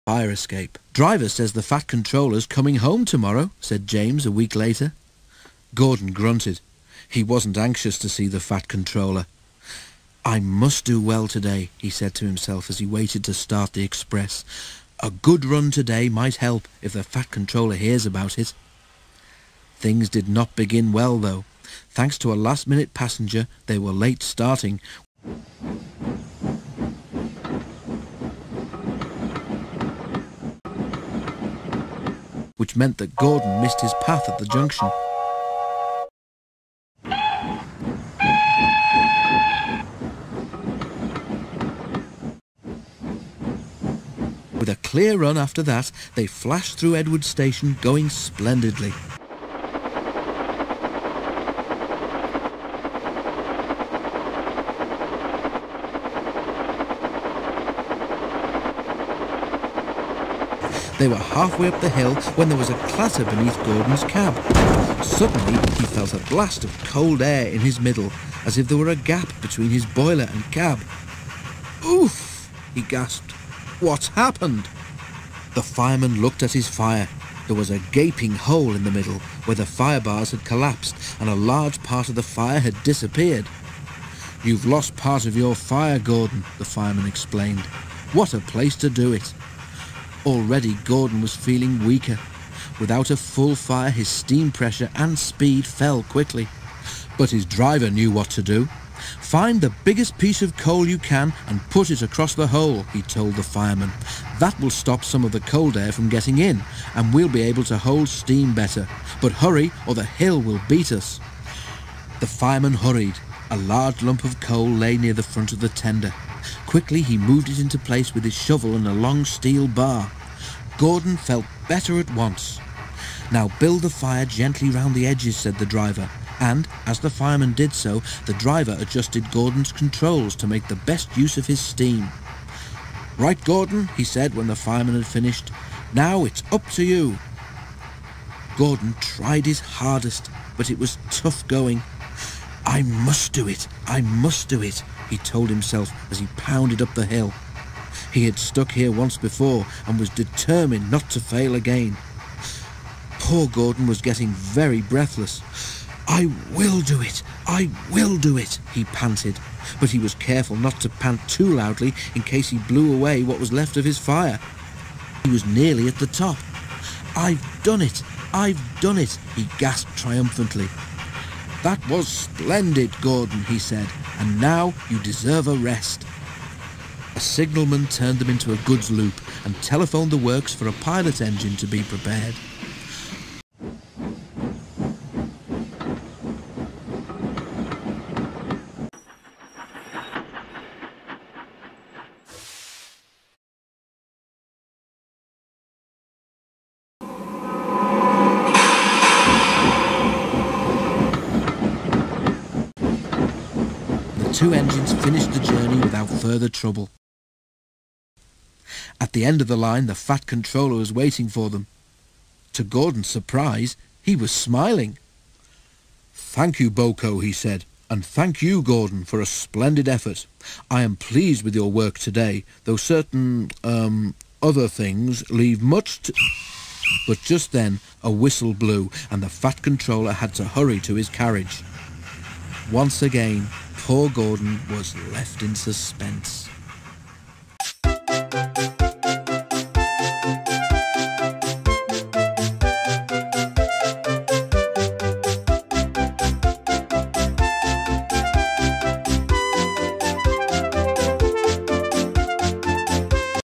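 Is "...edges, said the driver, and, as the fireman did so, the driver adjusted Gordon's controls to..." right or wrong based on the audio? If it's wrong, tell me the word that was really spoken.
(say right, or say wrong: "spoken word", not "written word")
right.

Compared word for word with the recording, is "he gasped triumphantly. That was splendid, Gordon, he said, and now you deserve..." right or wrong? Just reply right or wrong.
right.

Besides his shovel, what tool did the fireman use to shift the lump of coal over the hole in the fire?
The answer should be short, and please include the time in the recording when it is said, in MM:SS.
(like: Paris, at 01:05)
A long steel bar, at 01:58.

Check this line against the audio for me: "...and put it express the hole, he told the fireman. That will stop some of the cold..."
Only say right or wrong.
wrong.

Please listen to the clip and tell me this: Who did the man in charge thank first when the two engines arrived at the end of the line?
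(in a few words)
BoCo.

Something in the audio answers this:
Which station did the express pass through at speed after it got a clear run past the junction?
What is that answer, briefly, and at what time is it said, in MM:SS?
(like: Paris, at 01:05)
Edward Station, at 00:46.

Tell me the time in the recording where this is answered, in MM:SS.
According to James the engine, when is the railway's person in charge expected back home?
00:03.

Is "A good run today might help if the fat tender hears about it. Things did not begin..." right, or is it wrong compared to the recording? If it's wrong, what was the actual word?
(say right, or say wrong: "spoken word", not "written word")
wrong: "controller", not "tender".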